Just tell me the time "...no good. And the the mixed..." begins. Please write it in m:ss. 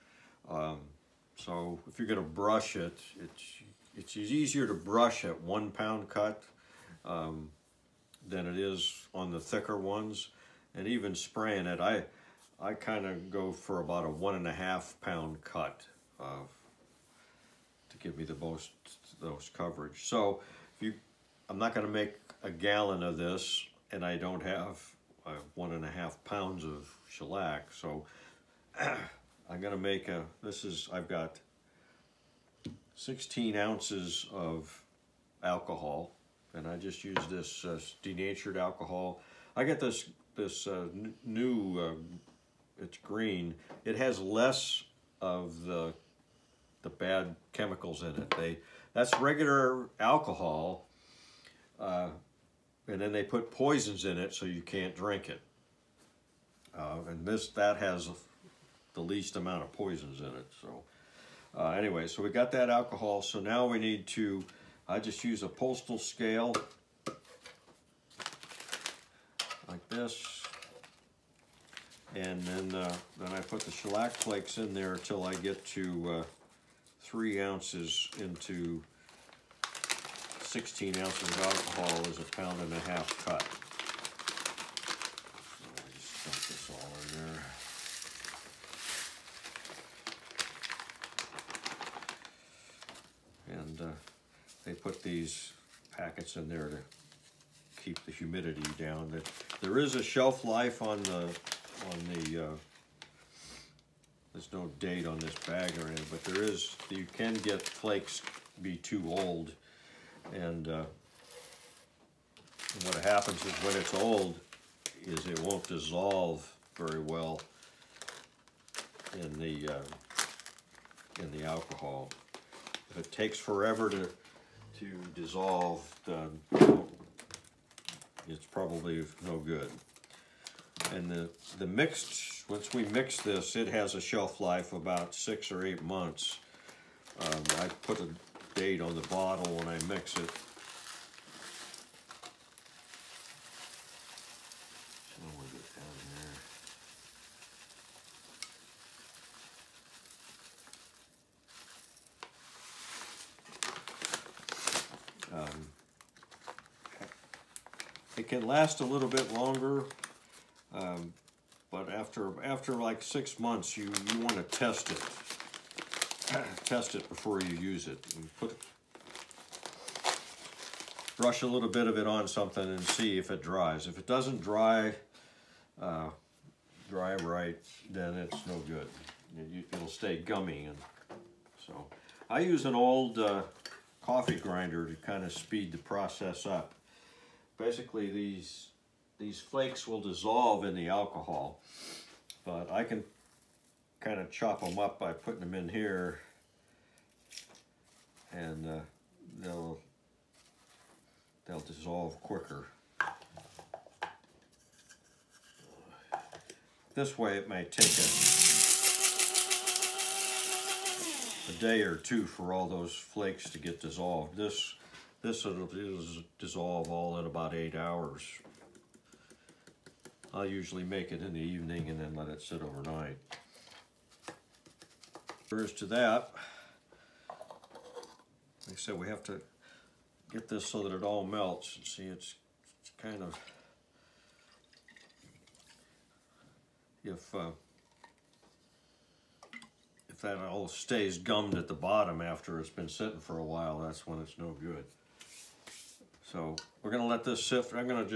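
2:09.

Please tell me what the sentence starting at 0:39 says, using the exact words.
I get this, this uh, new, uh, it's green.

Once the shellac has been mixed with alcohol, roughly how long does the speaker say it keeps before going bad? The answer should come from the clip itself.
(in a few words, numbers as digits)
6 or 8 months.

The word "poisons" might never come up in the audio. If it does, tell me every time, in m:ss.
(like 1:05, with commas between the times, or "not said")
0:53, 0:59.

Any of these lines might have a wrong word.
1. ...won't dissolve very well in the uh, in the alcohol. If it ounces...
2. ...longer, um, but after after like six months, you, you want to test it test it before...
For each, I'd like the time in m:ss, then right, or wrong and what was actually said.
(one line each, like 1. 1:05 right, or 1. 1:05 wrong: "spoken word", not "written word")
1. 1:55 wrong: "takes", not "ounces"
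2. 2:39 right.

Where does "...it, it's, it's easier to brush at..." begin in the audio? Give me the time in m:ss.
0:02.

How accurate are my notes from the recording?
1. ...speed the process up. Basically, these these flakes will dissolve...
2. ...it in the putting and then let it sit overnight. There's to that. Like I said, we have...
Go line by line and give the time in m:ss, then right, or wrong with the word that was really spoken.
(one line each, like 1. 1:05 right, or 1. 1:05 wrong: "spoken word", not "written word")
1. 3:05 right
2. 3:41 wrong: "evening", not "putting".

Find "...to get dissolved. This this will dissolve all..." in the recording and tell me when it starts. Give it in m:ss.
3:33.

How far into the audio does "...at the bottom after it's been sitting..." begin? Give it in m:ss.
4:01.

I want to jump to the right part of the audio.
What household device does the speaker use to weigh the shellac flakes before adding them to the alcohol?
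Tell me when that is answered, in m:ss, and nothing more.
1:05.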